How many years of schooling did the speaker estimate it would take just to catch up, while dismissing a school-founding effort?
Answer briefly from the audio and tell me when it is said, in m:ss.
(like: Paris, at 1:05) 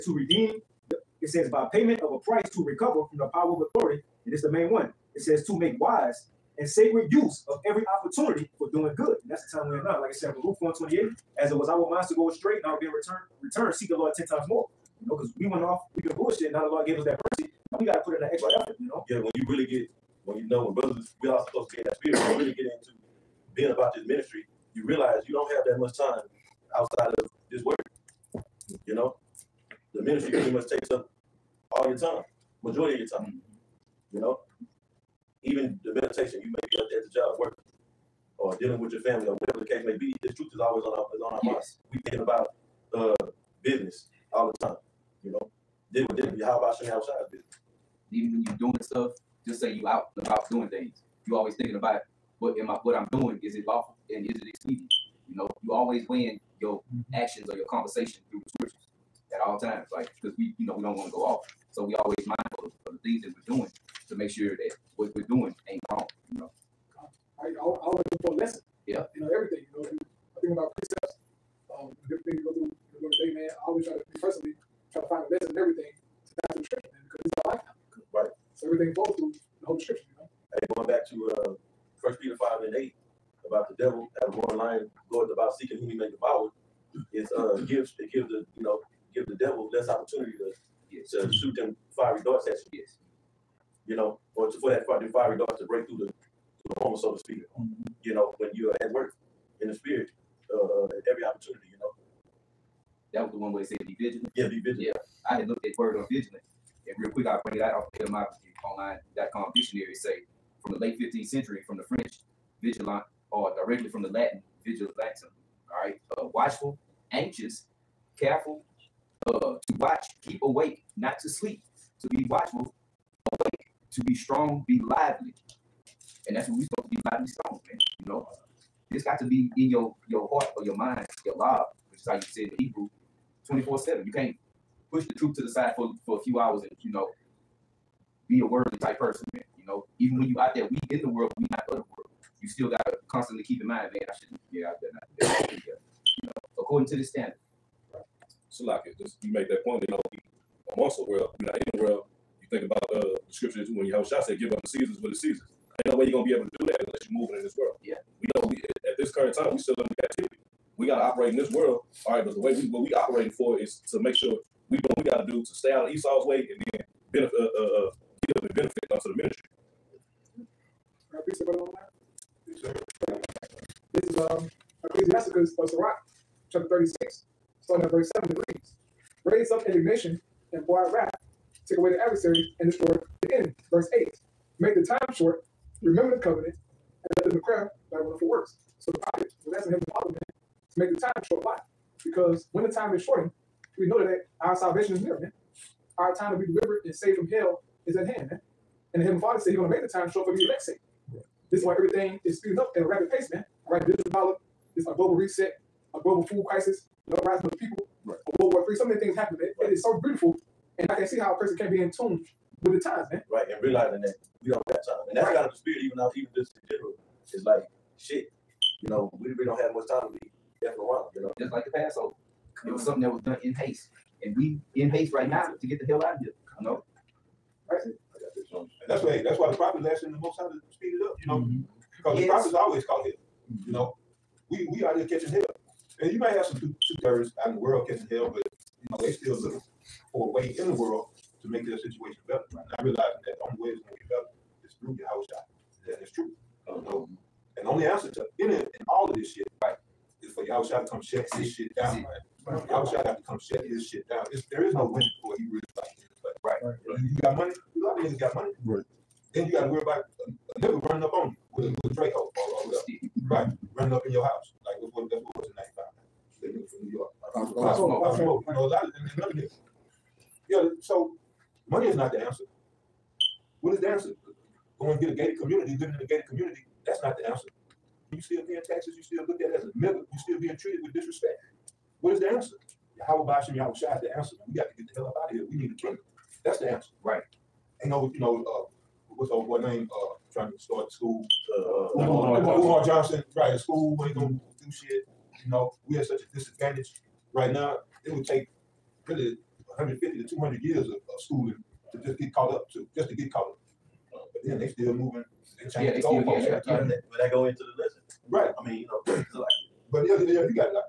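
150 to 200 years, at 4:59.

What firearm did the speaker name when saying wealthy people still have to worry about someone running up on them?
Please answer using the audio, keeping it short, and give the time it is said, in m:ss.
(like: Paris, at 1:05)
Draco, at 4:21.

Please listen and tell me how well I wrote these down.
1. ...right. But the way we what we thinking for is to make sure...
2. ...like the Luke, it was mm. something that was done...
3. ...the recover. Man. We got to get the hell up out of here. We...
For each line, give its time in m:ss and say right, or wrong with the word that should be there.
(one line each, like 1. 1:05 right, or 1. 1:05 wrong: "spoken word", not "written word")
1. 2:42 wrong: "operating", not "thinking"
2. 3:41 wrong: "Passover", not "Luke"
3. 4:44 wrong: "answer", not "recover".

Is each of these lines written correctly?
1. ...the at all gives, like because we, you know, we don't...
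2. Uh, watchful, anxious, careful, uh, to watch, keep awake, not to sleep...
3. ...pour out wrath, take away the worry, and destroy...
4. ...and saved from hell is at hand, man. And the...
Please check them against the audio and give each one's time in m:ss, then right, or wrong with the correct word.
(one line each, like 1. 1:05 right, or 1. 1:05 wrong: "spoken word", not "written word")
1. 0:58 wrong: "times", not "gives"
2. 1:56 right
3. 3:00 wrong: "adversary", not "worry"
4. 3:16 right.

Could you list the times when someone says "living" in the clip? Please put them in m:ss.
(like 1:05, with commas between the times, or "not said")
4:35.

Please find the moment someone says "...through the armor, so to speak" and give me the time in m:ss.
1:36.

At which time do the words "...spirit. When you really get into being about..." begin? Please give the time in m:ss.
0:21.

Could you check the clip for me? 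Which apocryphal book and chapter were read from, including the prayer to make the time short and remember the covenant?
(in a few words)
Sirach 36.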